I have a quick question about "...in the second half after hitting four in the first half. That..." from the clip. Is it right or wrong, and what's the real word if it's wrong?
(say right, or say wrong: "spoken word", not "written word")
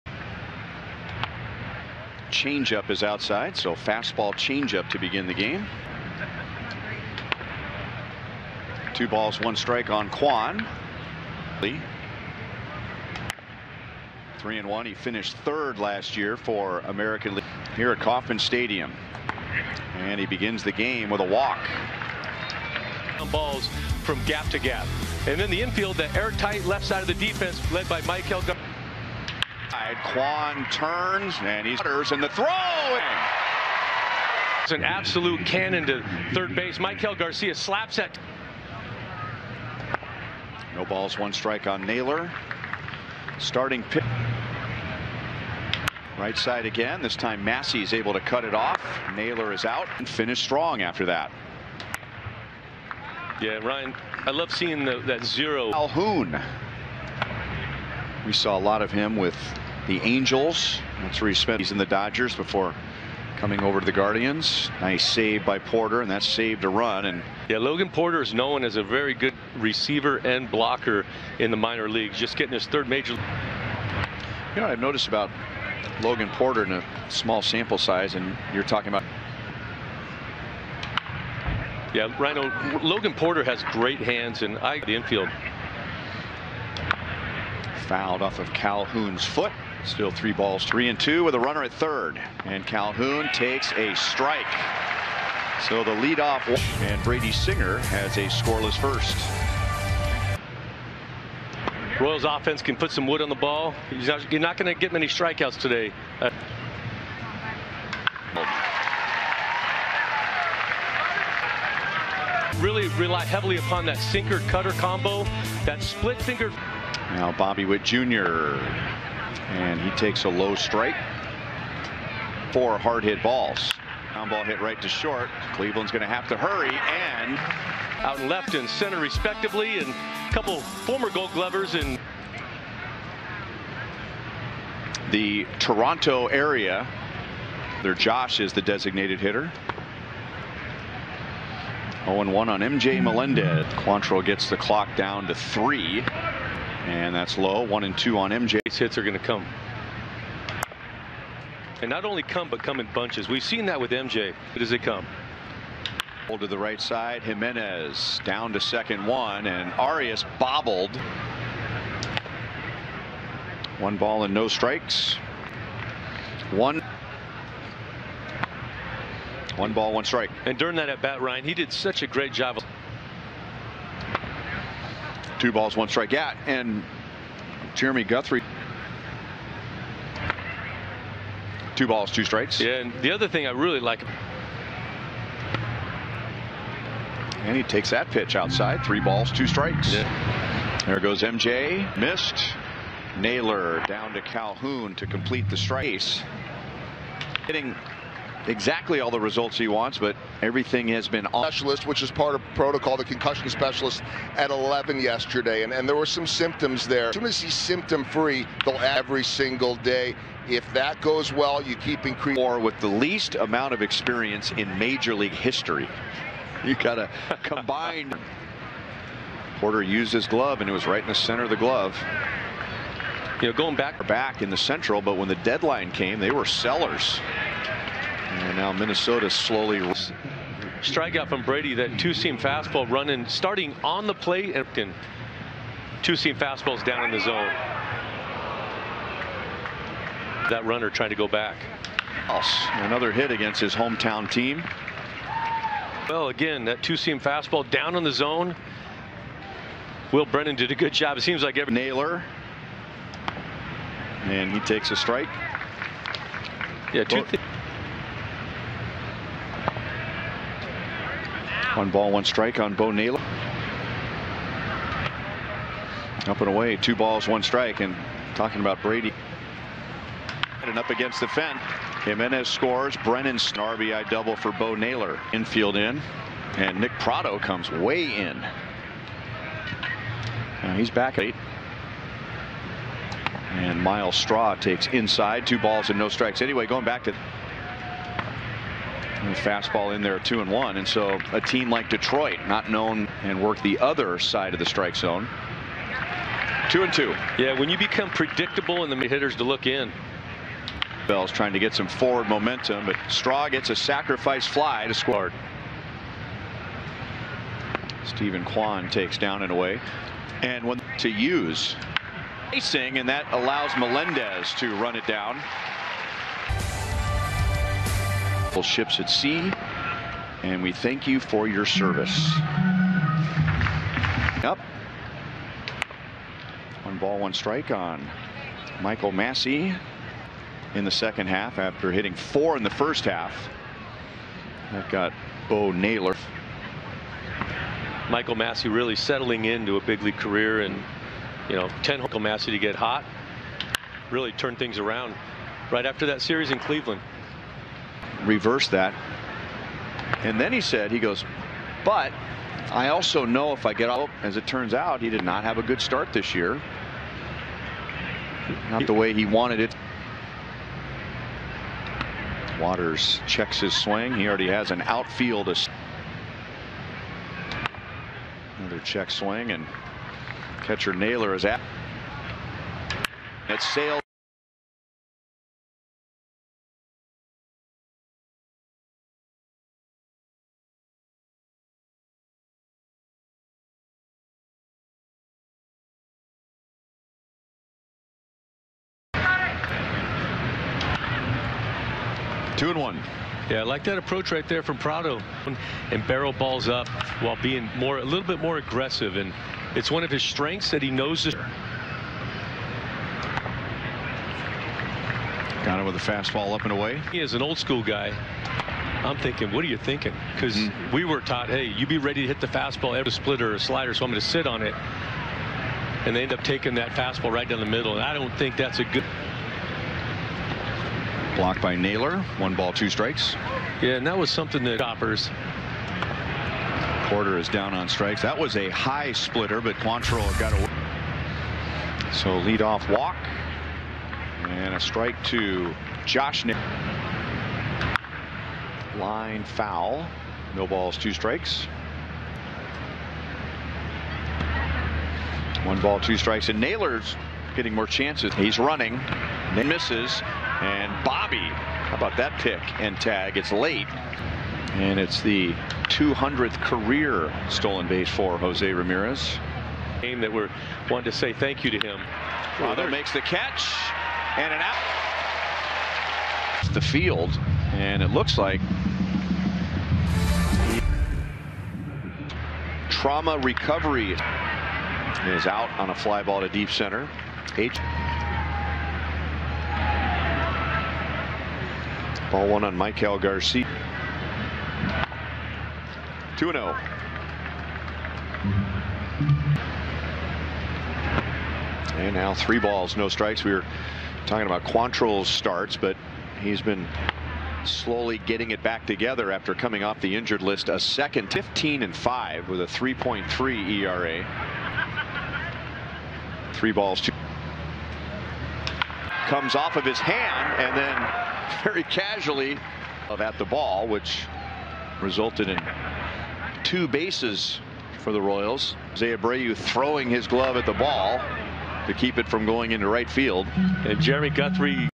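right.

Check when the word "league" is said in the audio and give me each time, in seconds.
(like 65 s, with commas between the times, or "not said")
17 s, 71 s, 215 s, 340 s.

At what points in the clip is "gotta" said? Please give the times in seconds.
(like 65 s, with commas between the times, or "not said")
216 s.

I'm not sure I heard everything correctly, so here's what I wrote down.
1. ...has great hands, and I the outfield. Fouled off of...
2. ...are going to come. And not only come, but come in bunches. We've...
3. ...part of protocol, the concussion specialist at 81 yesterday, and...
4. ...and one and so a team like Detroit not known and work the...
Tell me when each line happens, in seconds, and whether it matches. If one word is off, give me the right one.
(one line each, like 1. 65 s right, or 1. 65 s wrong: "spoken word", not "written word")
1. 83 s wrong: "infield", not "outfield"
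2. 148 s right
3. 202 s wrong: "11", not "81"
4. 290 s right.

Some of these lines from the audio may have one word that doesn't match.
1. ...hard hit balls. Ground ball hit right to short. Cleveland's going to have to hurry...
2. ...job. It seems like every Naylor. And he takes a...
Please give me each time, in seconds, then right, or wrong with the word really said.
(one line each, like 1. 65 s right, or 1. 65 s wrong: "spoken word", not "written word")
1. 122 s right
2. 250 s right.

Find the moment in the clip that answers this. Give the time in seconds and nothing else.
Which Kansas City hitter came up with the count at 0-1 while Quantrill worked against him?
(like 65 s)
142 s.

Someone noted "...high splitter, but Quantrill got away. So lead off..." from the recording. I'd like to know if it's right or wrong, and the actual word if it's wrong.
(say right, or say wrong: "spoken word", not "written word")
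right.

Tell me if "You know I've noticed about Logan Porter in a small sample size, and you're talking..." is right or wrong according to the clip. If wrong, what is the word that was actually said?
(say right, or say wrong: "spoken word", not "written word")
right.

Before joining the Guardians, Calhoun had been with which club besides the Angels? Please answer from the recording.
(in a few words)
Dodgers.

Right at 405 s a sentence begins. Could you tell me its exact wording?
Got him with a fastball up and away.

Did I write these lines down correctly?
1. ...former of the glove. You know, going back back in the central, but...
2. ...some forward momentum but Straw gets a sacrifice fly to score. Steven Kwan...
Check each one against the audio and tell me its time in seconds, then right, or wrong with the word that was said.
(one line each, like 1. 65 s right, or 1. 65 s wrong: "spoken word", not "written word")
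1. 221 s wrong: "center", not "former"
2. 301 s right.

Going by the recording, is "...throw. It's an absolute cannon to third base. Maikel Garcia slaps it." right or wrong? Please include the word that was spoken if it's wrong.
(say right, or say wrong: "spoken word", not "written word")
right.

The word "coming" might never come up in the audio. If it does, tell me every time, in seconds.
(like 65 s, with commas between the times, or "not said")
63 s, 499 s.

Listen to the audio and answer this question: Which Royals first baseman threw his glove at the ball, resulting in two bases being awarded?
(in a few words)
Jose Abreu.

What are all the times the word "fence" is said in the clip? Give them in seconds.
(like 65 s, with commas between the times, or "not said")
271 s.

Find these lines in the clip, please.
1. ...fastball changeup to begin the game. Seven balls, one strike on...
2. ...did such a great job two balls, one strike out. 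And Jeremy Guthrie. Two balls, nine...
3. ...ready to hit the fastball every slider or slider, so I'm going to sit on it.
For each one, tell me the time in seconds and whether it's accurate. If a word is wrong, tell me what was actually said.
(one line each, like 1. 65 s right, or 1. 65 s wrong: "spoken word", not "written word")
1. 3 s wrong: "Two", not "Seven"
2. 171 s wrong: "two", not "nine"
3. 411 s wrong: "splitter", not "slider".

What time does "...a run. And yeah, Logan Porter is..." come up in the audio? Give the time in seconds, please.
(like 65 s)
66 s.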